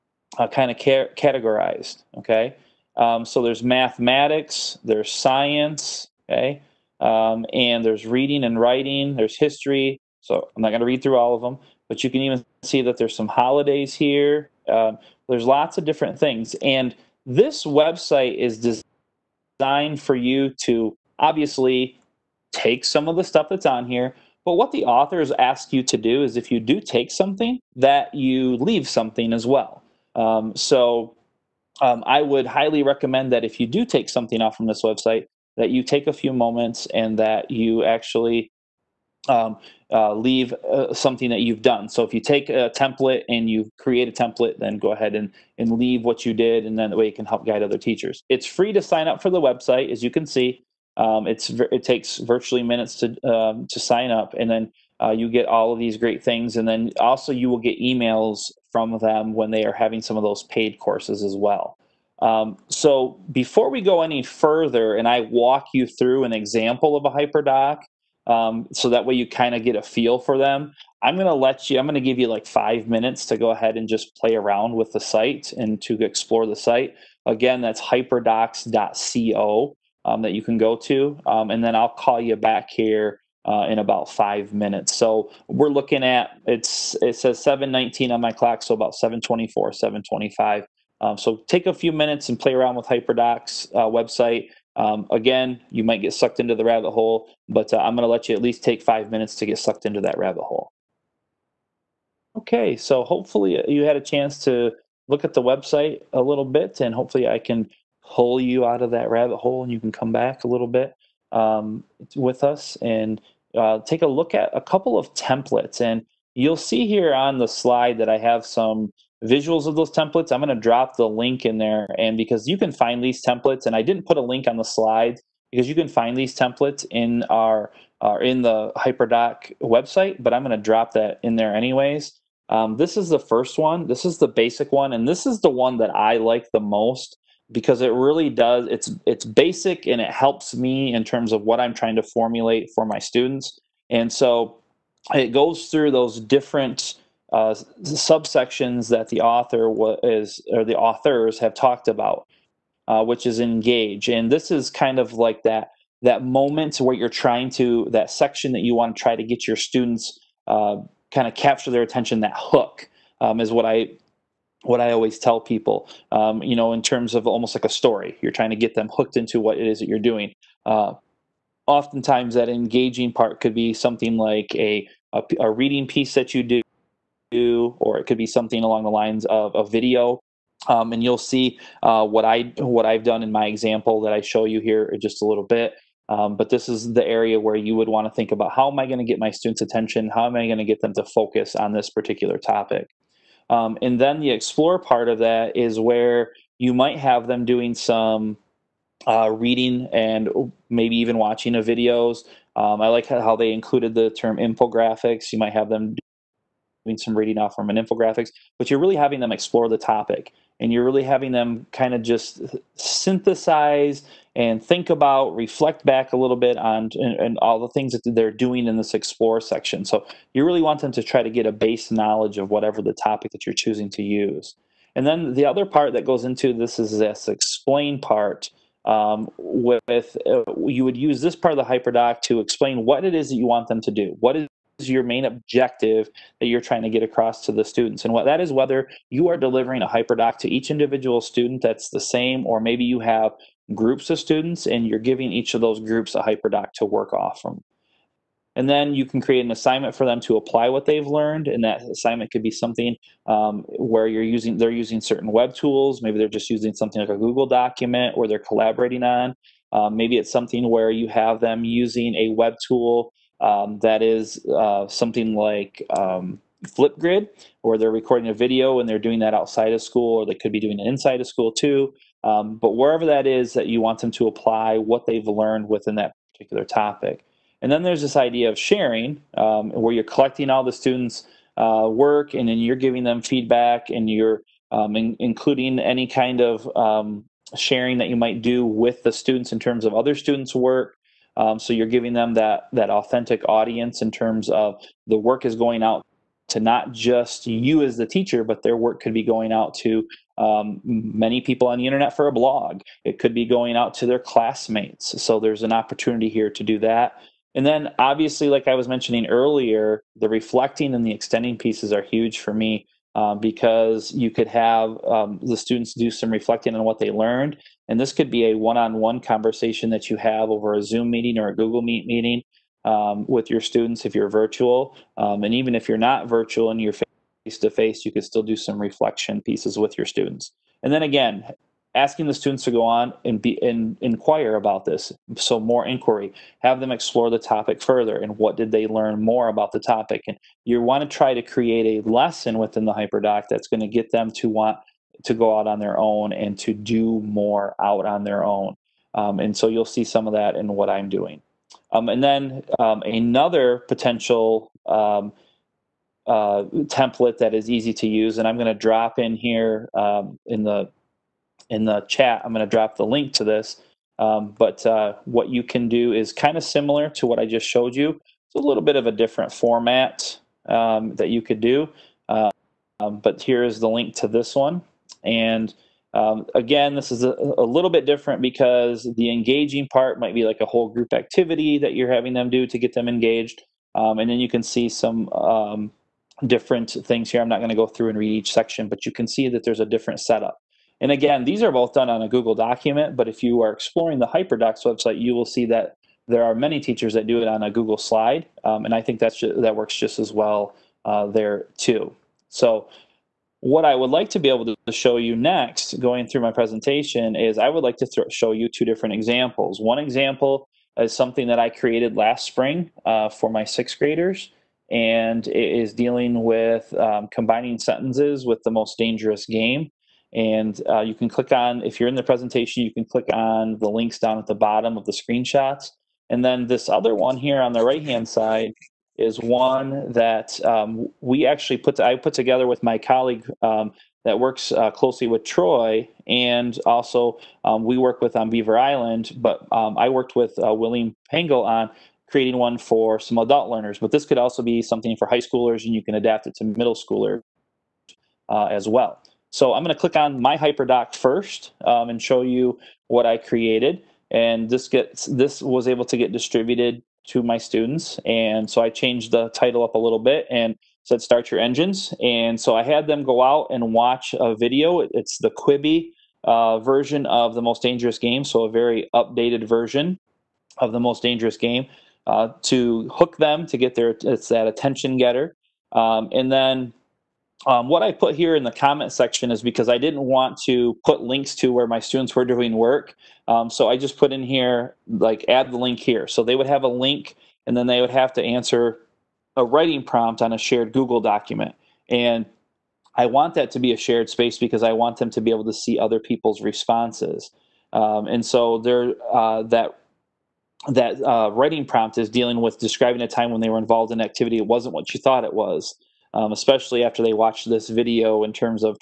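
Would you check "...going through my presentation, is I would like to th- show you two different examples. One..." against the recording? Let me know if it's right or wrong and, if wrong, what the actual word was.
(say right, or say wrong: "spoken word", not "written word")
right.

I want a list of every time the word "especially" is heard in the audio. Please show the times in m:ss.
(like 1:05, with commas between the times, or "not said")
8:26.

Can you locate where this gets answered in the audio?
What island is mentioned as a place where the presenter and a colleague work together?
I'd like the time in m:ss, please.
7:18.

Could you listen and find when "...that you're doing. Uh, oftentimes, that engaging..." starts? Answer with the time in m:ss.
2:49.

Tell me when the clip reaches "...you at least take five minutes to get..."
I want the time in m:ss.
1:38.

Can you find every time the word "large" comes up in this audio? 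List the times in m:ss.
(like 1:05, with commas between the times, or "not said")
not said.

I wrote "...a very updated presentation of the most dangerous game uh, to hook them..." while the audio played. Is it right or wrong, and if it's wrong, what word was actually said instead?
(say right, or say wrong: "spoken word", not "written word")
wrong: "version", not "presentation".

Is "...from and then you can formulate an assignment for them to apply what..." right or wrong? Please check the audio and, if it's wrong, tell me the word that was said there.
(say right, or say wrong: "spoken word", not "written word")
wrong: "create", not "formulate".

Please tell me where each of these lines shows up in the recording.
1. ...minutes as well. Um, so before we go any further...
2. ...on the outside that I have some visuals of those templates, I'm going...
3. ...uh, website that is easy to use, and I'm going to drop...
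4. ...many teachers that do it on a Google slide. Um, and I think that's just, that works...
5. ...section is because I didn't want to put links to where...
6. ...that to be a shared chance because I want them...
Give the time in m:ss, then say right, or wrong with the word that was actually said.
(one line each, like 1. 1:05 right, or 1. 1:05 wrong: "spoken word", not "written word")
1. 1:00 wrong: "courses", not "minutes"
2. 1:57 wrong: "slide", not "outside"
3. 5:56 wrong: "template", not "website"
4. 6:36 right
5. 7:59 right
6. 8:13 wrong: "space", not "chance".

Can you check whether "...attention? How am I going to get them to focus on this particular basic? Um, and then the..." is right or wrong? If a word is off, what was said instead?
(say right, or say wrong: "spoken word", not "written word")
wrong: "topic", not "basic".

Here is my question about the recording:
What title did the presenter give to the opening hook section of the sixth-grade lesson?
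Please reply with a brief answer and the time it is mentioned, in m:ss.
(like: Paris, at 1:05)
Start Your Engines, at 7:41.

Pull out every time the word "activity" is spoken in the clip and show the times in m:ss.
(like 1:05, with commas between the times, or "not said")
6:21, 8:24.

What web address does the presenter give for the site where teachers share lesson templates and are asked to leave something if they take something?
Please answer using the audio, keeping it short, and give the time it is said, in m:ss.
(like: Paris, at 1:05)
hyperdocs.co, at 1:17.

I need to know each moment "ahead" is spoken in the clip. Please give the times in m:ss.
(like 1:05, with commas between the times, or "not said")
0:44, 1:13.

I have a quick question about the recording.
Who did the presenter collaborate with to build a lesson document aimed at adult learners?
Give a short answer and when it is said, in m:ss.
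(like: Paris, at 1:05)
William Pengel, at 7:20.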